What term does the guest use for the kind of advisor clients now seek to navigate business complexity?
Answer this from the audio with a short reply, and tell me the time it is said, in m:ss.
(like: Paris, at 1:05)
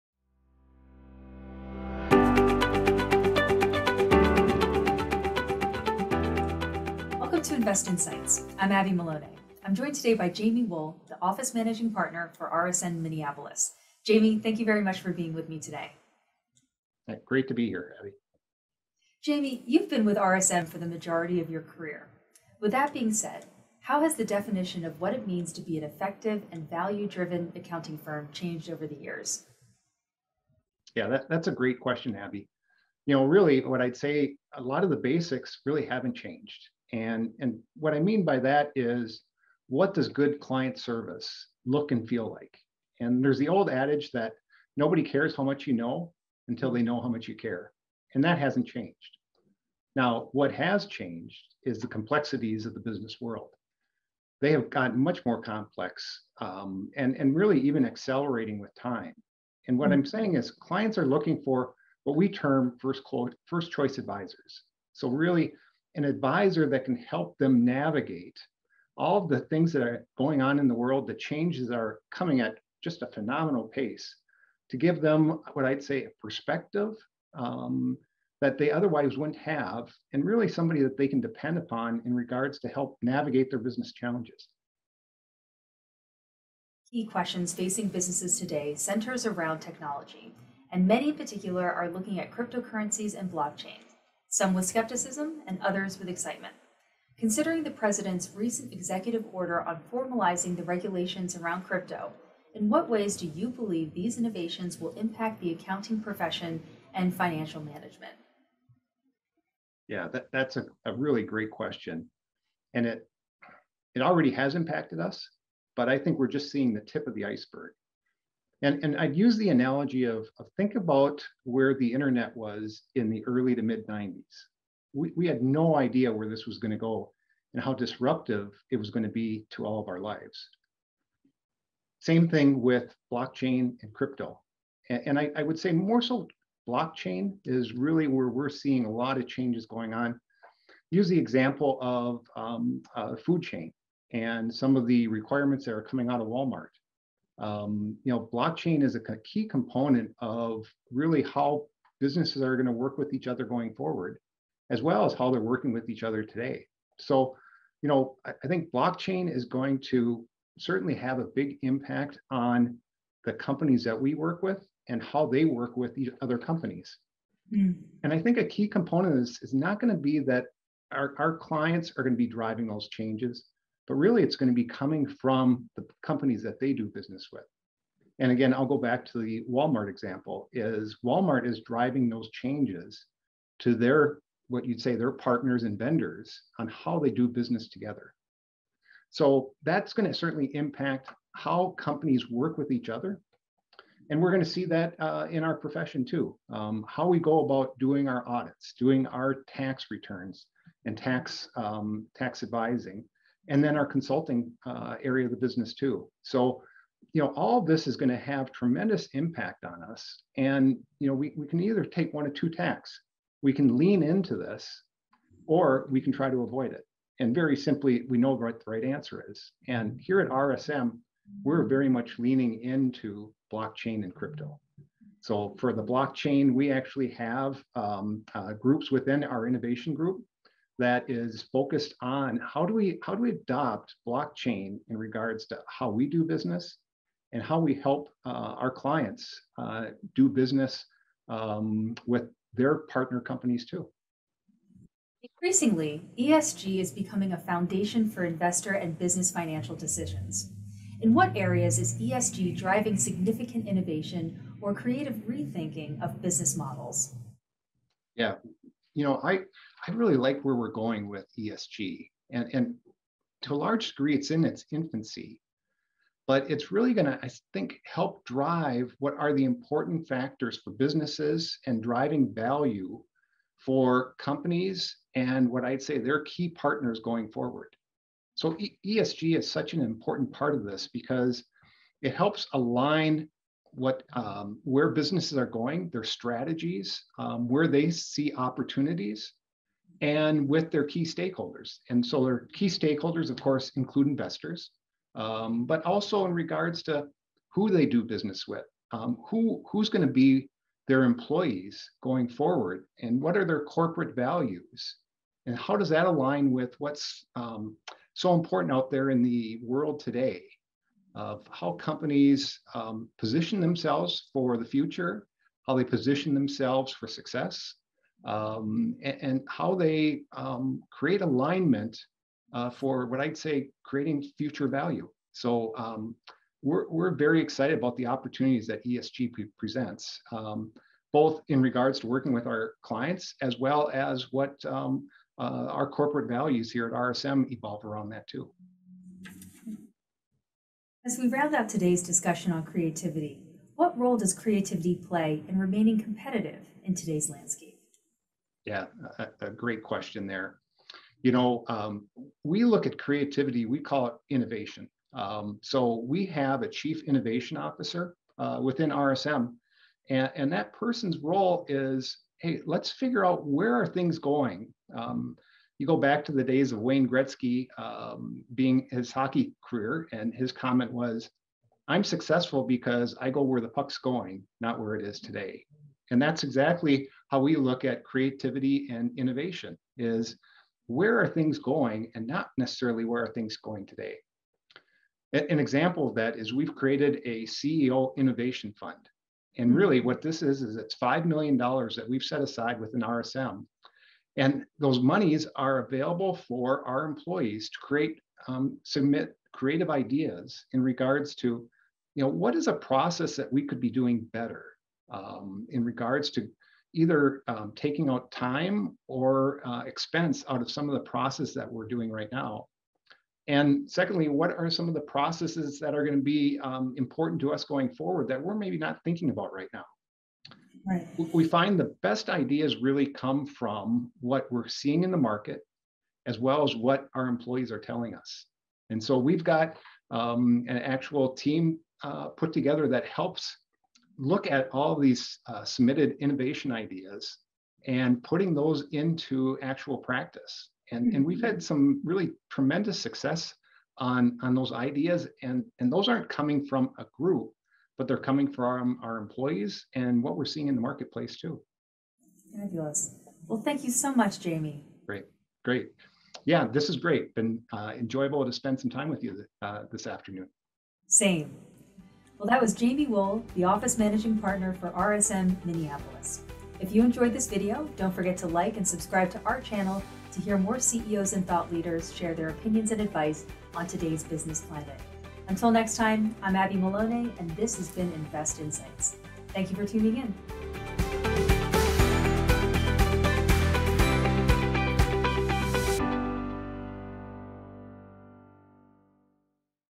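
first choice advisors, at 1:03.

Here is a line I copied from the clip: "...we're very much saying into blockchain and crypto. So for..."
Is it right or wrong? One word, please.
wrong.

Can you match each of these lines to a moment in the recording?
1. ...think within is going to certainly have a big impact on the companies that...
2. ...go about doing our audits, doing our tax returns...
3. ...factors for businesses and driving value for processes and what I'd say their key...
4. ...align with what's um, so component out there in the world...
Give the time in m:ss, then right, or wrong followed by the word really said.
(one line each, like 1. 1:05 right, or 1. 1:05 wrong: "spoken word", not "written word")
1. 2:38 wrong: "blockchain", not "within"
2. 3:17 right
3. 4:30 wrong: "companies", not "processes"
4. 5:06 wrong: "important", not "component".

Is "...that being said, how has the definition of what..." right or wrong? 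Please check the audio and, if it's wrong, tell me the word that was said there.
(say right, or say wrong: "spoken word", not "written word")
right.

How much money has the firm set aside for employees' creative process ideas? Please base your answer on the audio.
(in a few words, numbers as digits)
$5 million.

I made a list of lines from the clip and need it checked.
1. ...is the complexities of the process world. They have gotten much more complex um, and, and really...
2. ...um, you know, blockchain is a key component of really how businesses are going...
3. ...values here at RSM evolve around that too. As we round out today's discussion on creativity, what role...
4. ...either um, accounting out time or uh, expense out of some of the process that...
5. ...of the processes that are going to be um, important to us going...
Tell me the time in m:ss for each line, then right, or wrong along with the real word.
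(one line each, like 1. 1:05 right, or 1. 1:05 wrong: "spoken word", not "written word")
1. 0:51 wrong: "business", not "process"
2. 2:27 right
3. 5:36 right
4. 6:46 wrong: "taking", not "accounting"
5. 6:54 right.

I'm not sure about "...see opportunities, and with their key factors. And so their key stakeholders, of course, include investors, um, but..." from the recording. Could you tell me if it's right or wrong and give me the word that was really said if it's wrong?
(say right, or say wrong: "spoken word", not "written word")
wrong: "stakeholders", not "factors".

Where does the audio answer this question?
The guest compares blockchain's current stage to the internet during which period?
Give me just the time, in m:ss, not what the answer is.
2:03.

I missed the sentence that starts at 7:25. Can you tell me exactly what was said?
And, and those aren't coming from a group, but they're coming from our employees and what we're seeing in the marketplace too.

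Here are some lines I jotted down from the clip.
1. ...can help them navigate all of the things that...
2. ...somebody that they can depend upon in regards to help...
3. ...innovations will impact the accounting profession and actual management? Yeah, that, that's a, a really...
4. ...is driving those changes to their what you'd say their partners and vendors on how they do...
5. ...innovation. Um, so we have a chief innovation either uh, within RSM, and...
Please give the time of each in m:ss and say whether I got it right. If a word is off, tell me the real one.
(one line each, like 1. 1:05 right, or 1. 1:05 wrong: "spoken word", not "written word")
1. 1:06 right
2. 1:20 right
3. 1:44 wrong: "financial", not "actual"
4. 3:01 right
5. 5:54 wrong: "officer", not "either".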